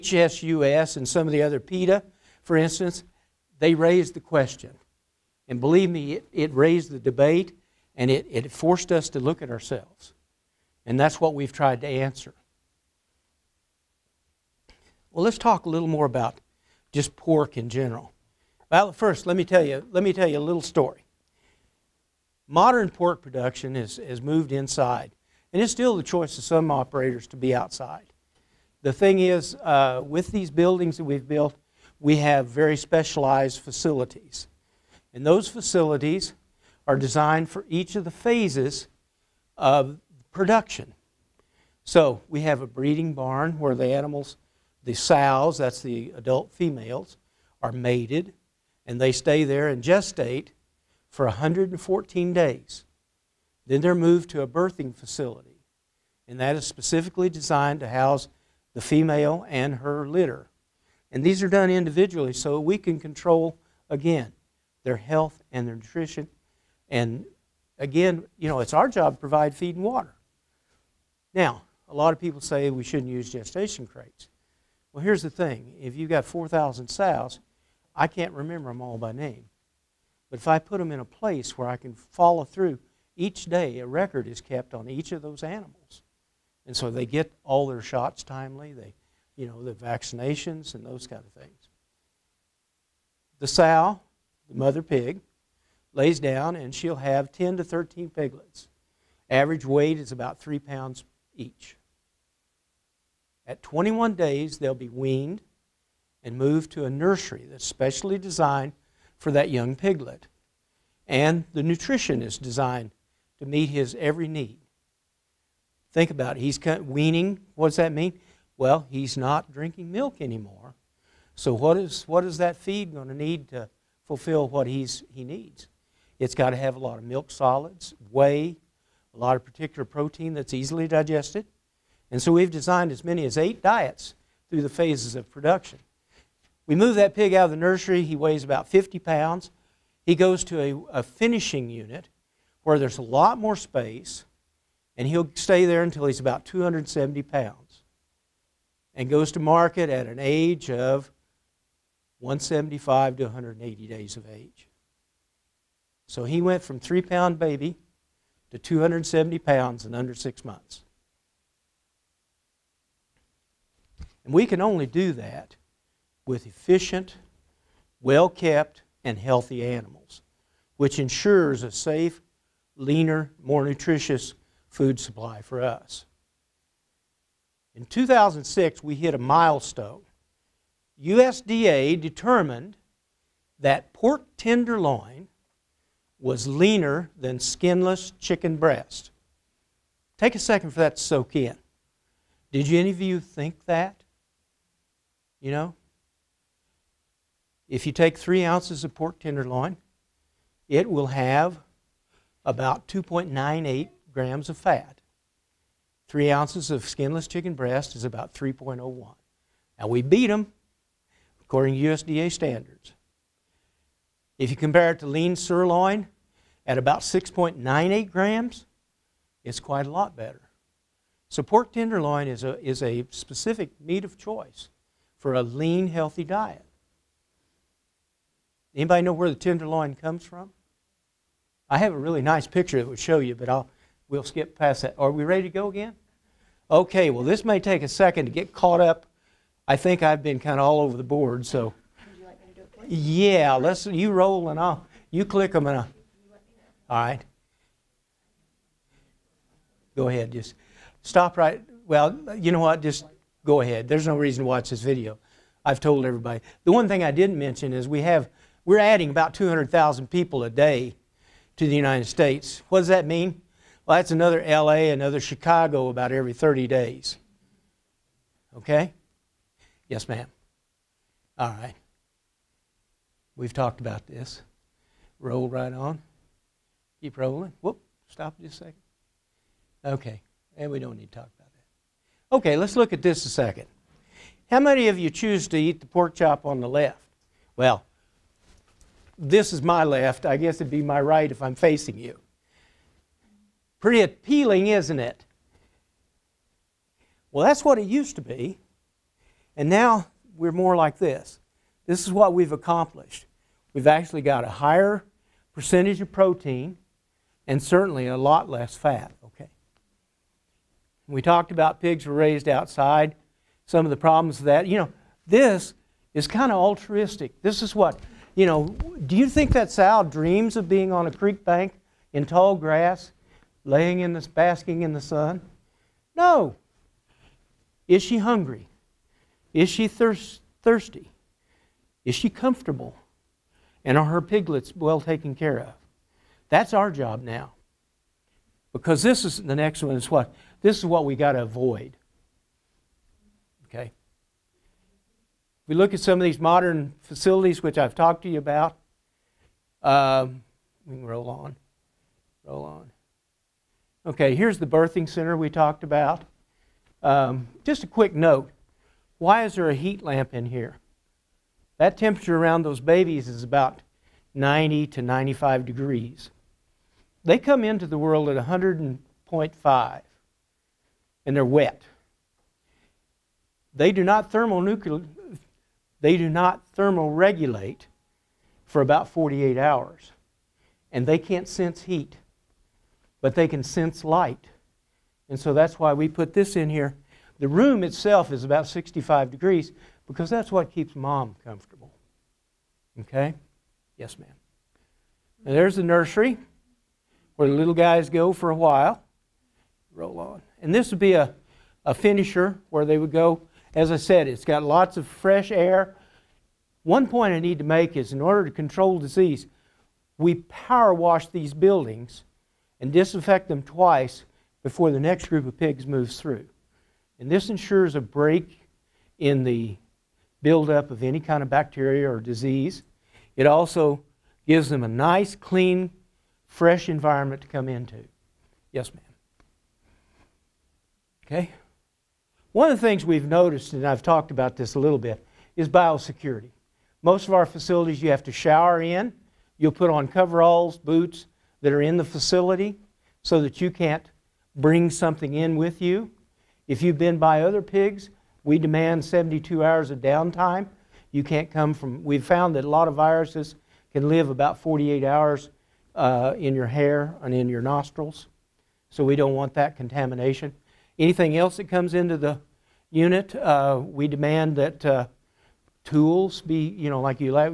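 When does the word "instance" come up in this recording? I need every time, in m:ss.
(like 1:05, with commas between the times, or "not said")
0:02.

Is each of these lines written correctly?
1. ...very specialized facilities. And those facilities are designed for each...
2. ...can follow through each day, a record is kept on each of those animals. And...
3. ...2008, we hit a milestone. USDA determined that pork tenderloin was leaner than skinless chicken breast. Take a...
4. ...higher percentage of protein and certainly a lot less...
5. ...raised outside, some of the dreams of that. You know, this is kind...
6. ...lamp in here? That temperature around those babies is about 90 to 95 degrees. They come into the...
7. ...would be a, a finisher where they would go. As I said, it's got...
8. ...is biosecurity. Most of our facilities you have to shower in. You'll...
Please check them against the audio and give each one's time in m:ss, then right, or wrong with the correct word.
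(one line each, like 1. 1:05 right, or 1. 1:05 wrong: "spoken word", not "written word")
1. 0:32 right
2. 1:21 right
3. 2:57 wrong: "2006", not "2008"
4. 5:04 right
5. 5:12 wrong: "problems", not "dreams"
6. 6:00 right
7. 6:40 right
8. 7:15 right.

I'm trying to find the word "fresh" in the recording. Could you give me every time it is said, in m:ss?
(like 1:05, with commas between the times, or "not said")
6:45, 7:06.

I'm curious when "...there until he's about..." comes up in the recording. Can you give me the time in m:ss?
2:25.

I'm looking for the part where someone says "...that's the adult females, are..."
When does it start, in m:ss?
0:45.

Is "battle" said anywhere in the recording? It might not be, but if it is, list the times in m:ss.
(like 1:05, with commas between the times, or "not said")
not said.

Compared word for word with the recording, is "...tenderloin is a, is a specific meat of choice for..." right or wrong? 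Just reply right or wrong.
right.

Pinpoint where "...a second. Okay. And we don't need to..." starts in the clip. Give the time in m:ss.
4:38.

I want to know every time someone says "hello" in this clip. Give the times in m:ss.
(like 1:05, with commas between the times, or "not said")
not said.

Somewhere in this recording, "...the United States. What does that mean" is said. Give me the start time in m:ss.
4:21.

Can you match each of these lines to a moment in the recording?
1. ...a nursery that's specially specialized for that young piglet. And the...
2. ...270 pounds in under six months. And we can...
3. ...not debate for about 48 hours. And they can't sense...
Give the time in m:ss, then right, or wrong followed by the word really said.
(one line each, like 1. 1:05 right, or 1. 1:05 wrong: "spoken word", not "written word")
1. 1:46 wrong: "designed", not "specialized"
2. 2:38 right
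3. 6:16 wrong: "thermoregulate", not "debate".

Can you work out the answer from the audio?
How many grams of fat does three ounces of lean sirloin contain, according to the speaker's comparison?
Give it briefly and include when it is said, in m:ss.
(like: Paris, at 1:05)
6.98 grams, at 3:36.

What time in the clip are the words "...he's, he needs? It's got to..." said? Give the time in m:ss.
2:04.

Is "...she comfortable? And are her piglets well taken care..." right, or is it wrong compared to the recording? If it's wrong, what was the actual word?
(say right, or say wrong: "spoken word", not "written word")
right.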